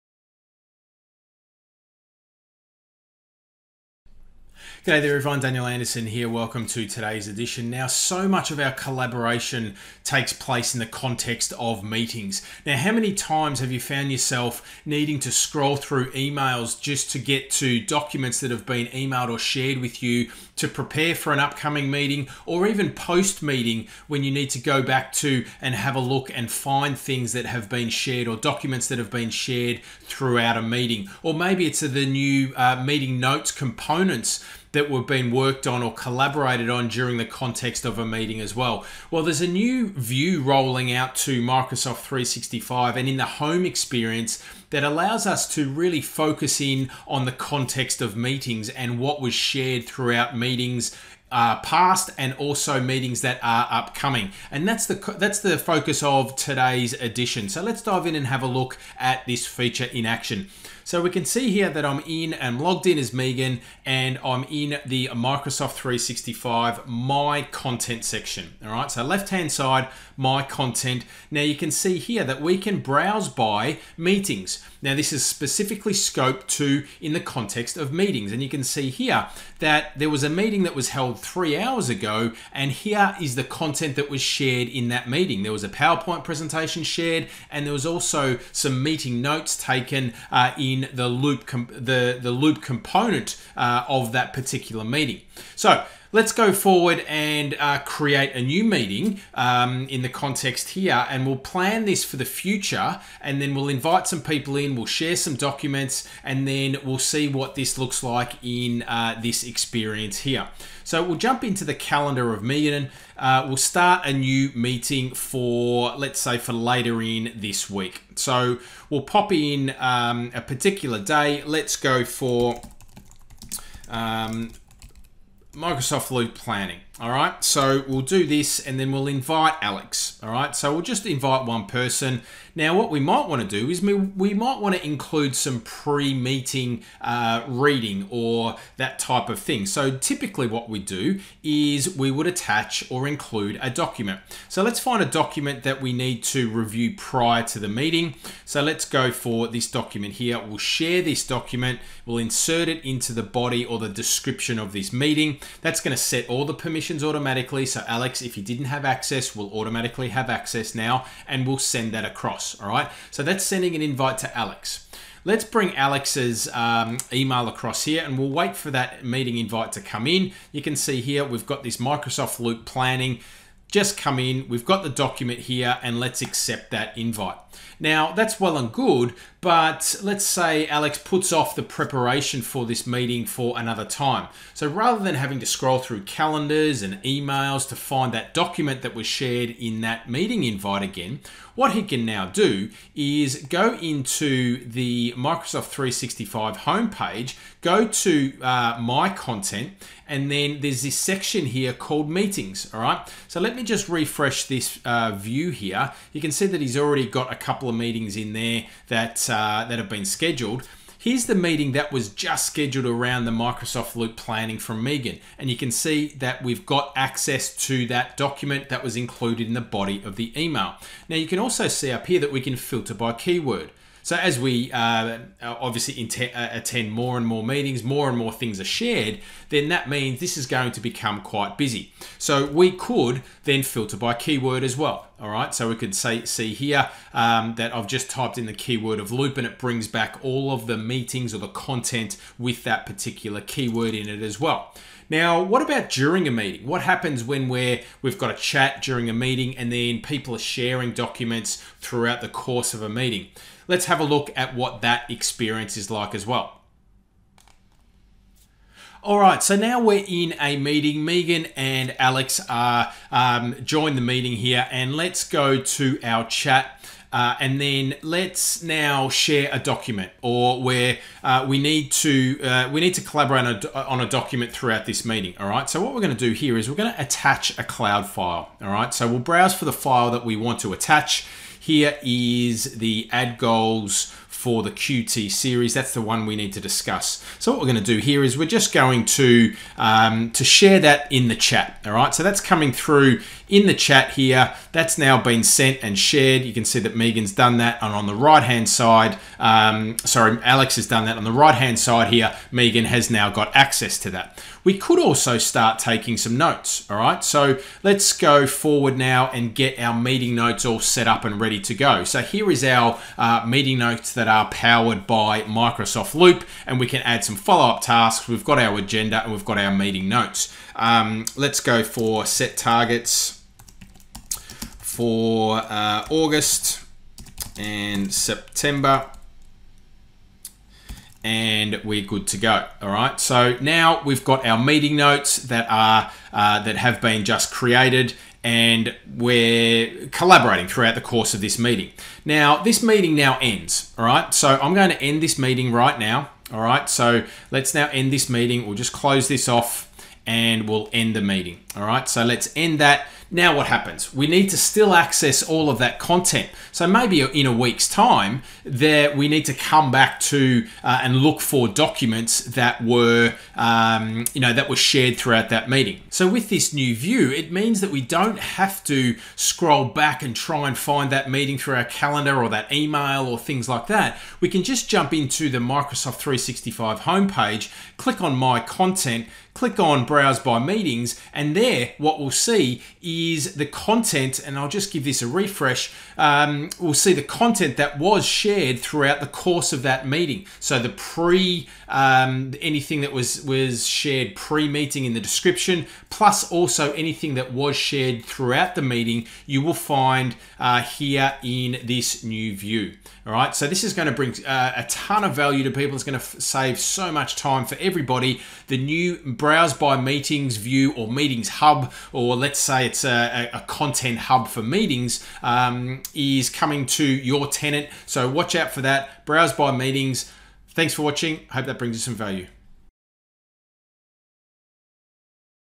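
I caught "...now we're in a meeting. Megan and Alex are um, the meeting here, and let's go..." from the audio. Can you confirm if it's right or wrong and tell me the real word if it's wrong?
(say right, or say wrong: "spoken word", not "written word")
right.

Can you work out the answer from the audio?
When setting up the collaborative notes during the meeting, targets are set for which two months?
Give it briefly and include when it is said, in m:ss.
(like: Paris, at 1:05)
August and September, at 5:26.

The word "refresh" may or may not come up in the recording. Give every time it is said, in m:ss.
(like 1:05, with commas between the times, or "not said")
3:23, 6:25.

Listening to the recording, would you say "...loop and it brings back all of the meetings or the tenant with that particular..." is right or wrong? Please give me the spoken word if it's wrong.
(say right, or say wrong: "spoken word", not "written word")
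wrong: "content", not "tenant".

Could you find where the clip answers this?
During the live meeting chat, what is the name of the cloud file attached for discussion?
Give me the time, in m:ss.
4:43.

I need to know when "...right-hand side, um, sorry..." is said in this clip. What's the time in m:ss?
4:58.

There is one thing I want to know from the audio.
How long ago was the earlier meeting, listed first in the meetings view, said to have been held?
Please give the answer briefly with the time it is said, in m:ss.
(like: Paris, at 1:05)
3 hours ago, at 1:21.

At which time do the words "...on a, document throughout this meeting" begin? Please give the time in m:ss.
4:33.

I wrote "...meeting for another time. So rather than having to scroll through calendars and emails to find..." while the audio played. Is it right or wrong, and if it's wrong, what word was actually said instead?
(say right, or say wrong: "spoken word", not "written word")
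right.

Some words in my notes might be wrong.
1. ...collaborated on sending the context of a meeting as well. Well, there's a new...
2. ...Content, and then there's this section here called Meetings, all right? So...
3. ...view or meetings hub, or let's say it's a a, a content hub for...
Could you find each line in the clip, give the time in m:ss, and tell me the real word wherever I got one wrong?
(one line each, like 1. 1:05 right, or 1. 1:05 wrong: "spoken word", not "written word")
1. 0:35 wrong: "during", not "sending"
2. 3:19 right
3. 6:50 right.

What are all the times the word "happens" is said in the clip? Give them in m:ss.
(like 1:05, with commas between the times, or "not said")
4:06, 5:53.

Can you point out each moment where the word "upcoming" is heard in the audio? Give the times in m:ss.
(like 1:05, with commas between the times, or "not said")
0:21, 0:53.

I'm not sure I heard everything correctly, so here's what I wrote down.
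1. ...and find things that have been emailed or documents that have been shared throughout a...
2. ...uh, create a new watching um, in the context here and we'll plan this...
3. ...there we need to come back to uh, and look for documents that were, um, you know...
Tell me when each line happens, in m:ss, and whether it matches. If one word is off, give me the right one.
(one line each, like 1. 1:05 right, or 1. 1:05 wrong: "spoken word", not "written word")
1. 0:26 wrong: "shared", not "emailed"
2. 1:37 wrong: "meeting", not "watching"
3. 5:58 right.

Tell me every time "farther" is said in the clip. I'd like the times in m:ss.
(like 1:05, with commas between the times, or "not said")
not said.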